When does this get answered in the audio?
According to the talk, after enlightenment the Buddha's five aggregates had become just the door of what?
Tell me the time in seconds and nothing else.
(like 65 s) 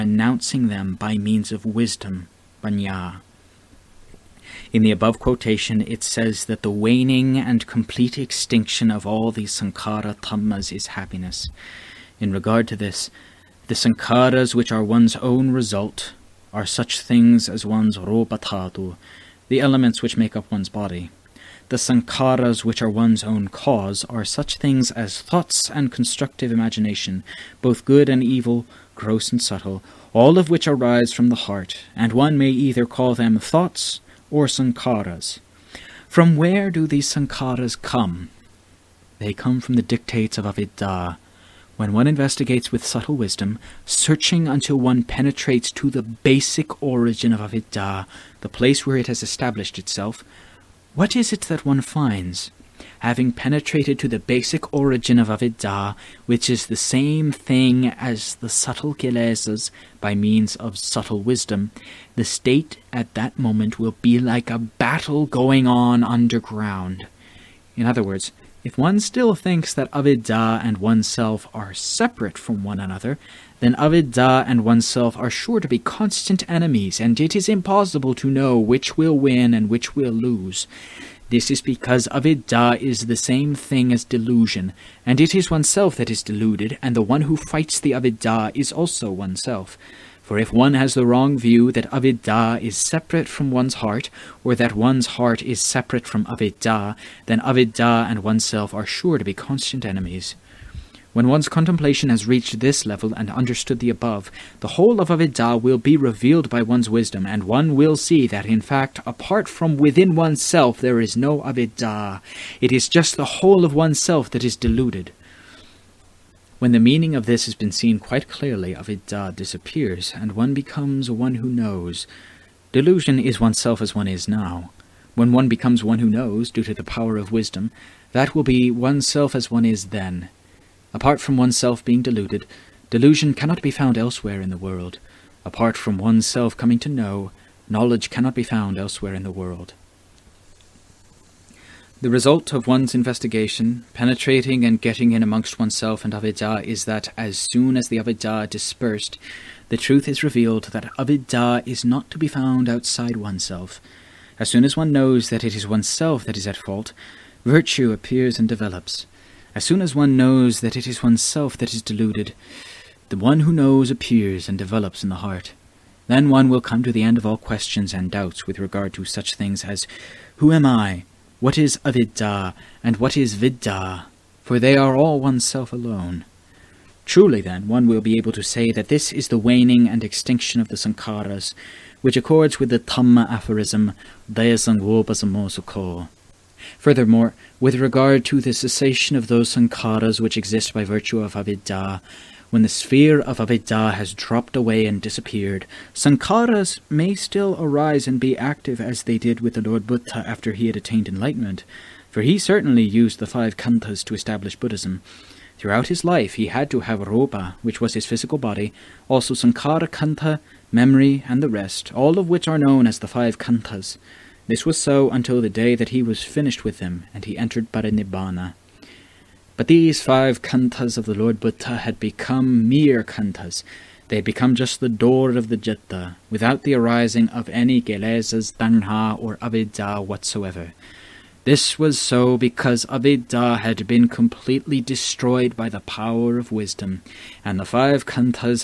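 225 s.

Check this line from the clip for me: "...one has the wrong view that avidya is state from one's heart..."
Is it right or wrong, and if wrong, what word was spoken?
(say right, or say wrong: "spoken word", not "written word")
wrong: "separate", not "state".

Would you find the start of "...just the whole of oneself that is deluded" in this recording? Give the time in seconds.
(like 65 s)
112 s.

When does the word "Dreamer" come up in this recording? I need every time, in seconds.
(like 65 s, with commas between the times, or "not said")
not said.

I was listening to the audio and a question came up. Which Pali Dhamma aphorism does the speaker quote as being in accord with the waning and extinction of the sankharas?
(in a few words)
Dayasangopasamosukho.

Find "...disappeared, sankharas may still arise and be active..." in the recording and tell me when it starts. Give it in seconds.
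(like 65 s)
195 s.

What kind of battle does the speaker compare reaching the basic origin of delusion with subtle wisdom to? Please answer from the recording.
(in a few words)
A battle going on underground.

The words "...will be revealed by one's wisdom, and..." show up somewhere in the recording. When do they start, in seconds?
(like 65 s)
105 s.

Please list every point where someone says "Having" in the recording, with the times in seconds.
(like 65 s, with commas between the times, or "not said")
53 s.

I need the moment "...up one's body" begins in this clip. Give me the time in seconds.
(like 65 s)
20 s.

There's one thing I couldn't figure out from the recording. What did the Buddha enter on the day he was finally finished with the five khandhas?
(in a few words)
Parinibbana.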